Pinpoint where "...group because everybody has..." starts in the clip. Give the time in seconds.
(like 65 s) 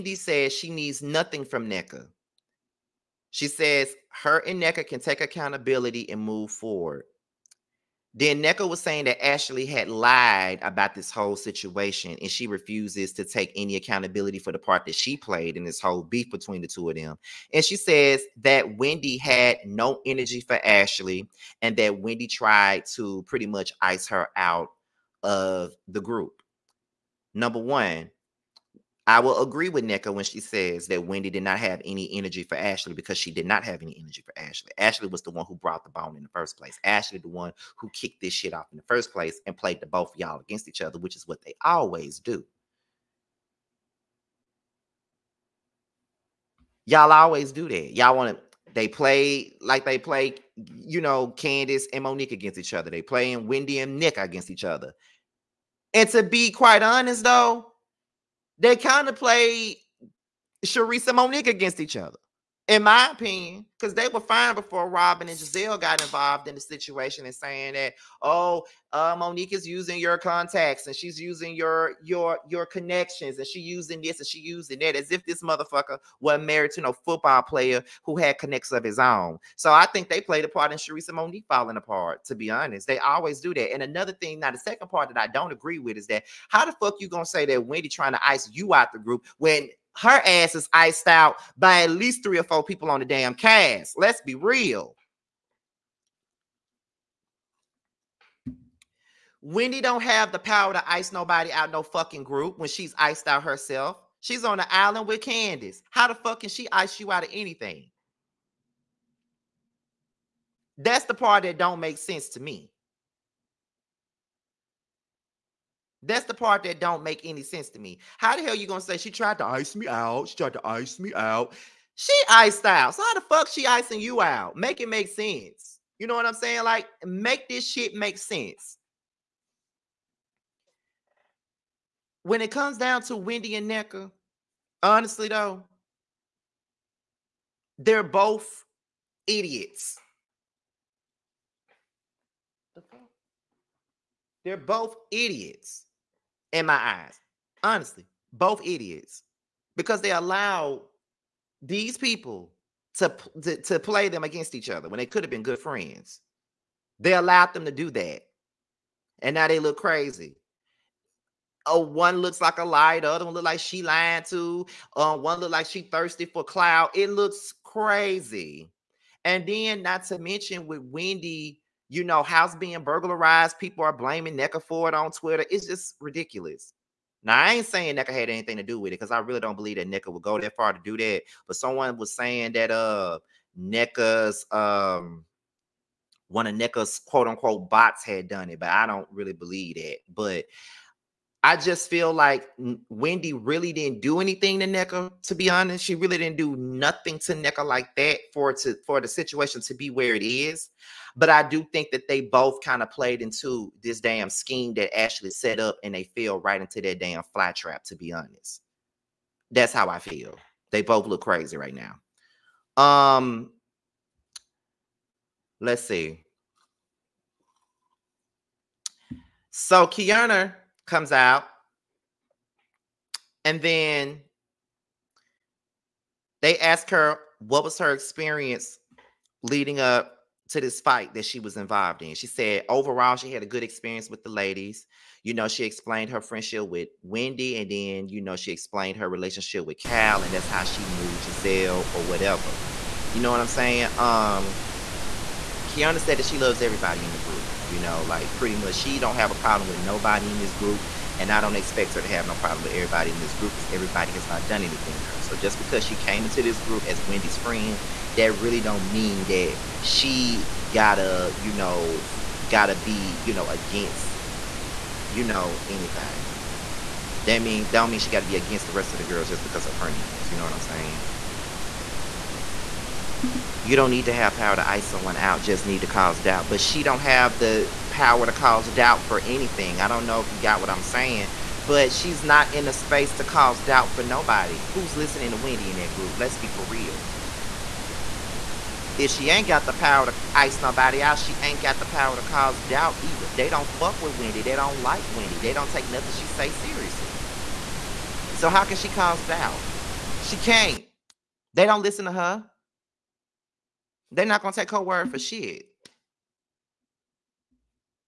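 253 s.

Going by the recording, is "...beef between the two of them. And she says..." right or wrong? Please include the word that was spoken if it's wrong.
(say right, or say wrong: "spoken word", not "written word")
right.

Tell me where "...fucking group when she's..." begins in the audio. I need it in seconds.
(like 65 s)
101 s.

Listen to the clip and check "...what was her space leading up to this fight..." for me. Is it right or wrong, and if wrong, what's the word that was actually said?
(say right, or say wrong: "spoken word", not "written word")
wrong: "experience", not "space".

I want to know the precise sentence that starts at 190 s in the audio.
But I just feel like Wendy really didn't do anything to Nneka, to be honest.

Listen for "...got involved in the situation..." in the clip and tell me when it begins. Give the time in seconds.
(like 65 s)
65 s.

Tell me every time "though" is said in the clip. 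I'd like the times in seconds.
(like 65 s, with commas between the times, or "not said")
57 s, 135 s.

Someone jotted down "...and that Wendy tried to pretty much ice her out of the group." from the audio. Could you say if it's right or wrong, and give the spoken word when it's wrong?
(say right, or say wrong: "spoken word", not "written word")
right.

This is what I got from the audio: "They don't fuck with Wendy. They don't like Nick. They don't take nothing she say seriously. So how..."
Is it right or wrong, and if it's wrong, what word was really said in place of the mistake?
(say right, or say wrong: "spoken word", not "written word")
wrong: "Wendy", not "Nick".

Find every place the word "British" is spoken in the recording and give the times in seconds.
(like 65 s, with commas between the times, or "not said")
not said.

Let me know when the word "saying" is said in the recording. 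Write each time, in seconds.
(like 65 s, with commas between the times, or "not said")
8 s, 67 s, 126 s, 177 s, 182 s, 243 s, 270 s, 280 s.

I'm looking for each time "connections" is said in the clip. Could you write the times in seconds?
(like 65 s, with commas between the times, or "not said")
72 s, 78 s.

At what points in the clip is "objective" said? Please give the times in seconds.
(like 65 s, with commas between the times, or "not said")
not said.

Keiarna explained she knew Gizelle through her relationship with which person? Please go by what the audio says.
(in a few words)
Cal.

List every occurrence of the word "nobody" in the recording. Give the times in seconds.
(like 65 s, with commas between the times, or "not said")
101 s, 249 s, 284 s, 290 s.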